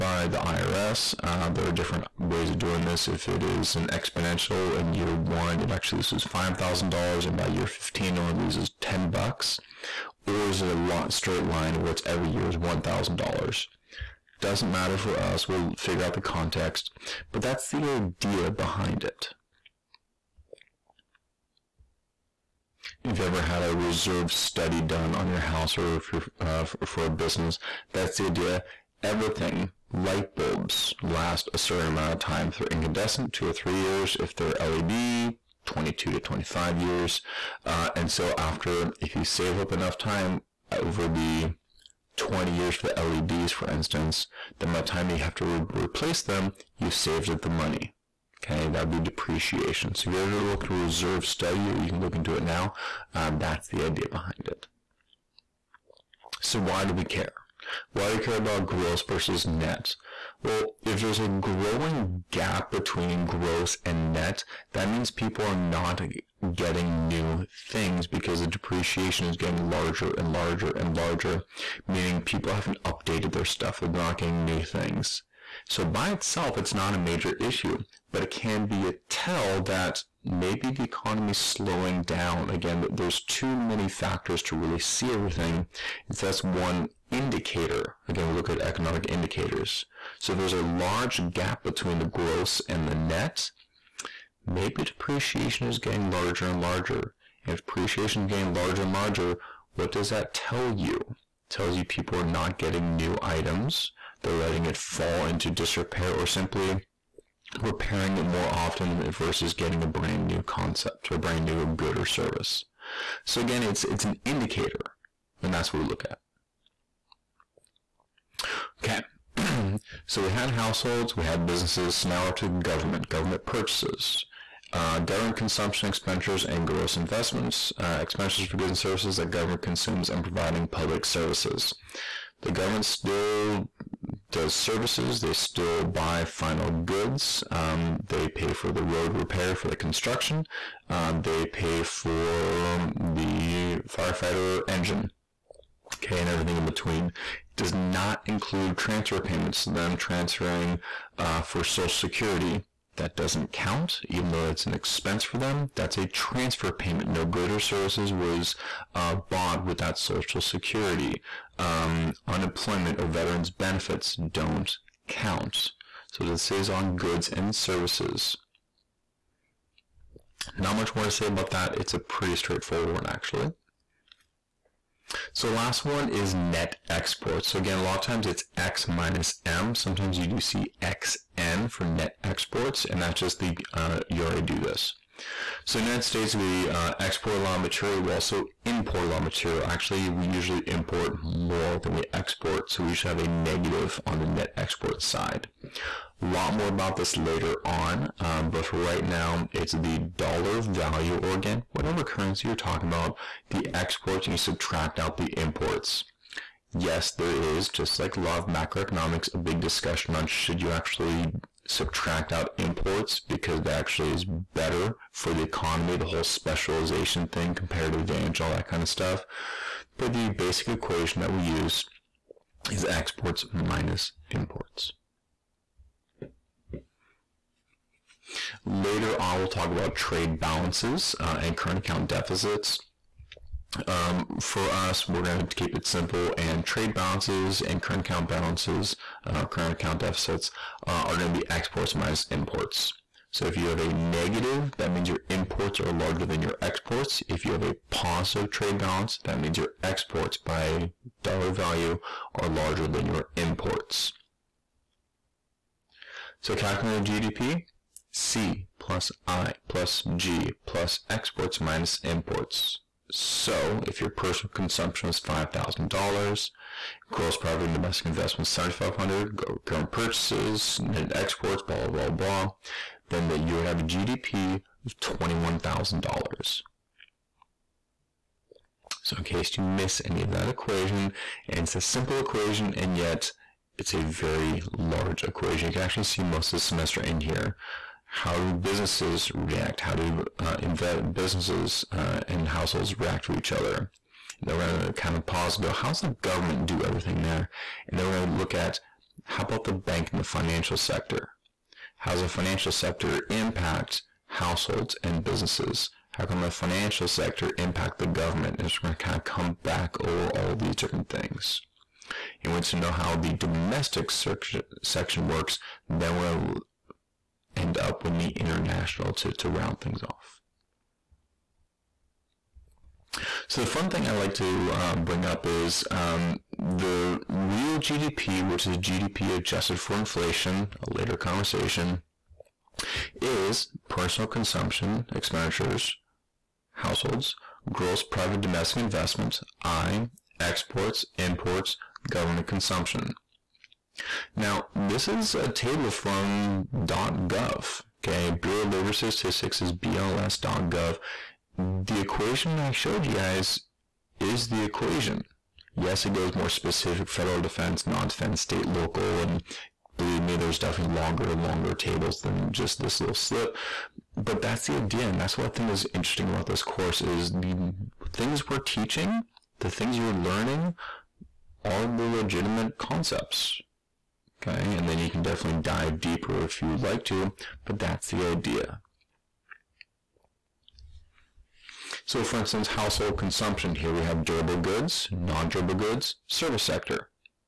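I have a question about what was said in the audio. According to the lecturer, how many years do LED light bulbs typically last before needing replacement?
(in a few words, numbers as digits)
22 to 25 years.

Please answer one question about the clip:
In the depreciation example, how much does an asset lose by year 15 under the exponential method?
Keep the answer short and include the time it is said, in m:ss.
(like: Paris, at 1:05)
$10, at 0:08.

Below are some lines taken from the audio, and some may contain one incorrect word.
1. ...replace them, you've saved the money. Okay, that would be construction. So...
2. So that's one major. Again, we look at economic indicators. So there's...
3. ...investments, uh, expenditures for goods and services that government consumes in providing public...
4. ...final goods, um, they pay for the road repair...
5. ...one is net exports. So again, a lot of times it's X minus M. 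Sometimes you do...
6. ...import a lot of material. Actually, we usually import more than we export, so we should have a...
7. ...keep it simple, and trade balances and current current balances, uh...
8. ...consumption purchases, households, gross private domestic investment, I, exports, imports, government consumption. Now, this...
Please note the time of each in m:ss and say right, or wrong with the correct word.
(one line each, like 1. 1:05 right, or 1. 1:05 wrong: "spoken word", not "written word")
1. 0:45 wrong: "depreciation", not "construction"
2. 1:26 wrong: "indicator", not "major"
3. 2:06 right
4. 2:16 right
5. 2:55 right
6. 3:08 right
7. 3:55 wrong: "account", not "current"
8. 5:34 wrong: "expenditures", not "purchases".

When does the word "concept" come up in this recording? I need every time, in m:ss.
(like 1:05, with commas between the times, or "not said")
1:50, 6:12.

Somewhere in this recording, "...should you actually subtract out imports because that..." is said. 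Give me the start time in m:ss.
3:30.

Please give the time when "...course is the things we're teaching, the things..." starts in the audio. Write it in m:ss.
6:06.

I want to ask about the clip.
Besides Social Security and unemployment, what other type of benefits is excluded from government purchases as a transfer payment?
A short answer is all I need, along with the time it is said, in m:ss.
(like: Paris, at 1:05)
Veterans benefits, at 2:43.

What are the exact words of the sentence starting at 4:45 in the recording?
You can actually see most of the semester in here how do businesses react?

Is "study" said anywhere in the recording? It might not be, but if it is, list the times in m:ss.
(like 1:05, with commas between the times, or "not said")
0:24, 0:51.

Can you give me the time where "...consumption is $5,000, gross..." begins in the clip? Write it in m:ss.
4:24.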